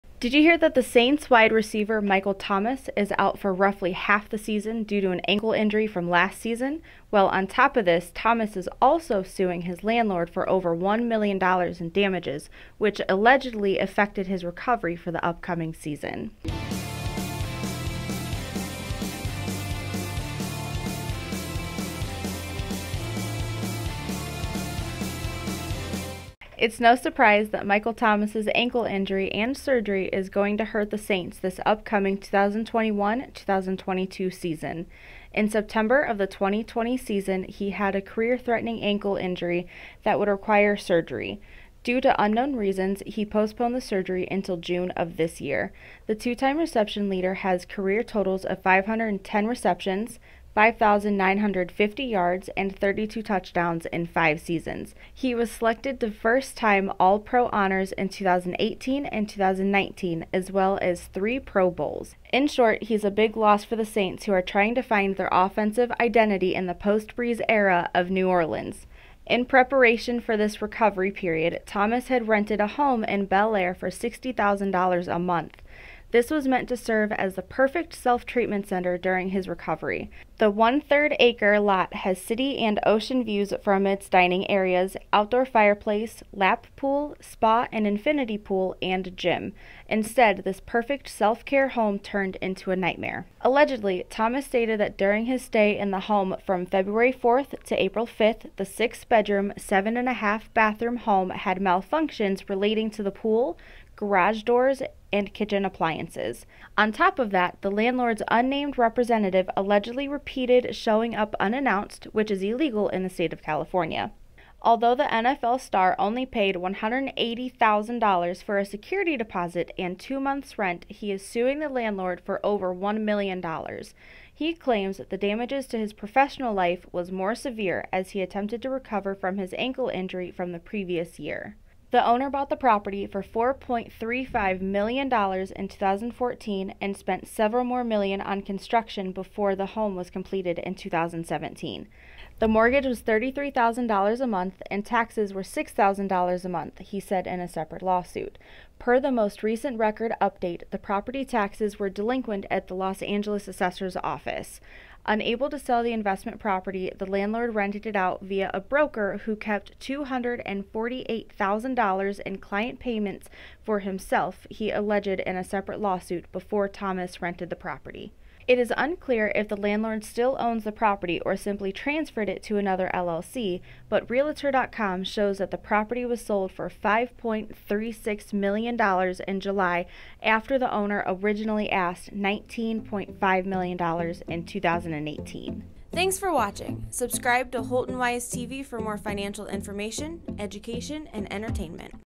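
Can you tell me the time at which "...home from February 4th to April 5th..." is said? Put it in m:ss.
1:36.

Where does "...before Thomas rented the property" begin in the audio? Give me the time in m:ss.
2:46.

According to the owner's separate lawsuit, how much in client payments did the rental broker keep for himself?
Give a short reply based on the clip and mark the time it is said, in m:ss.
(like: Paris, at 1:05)
$248,000, at 2:39.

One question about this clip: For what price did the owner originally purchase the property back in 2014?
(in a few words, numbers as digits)
$4.35 million.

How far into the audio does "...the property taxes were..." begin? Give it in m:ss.
2:30.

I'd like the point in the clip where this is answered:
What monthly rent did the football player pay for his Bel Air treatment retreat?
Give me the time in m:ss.
1:13.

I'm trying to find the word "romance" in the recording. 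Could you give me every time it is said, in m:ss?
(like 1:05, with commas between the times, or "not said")
not said.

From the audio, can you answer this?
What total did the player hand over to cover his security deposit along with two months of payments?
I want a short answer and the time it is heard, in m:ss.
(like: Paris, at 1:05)
$180,000, at 1:56.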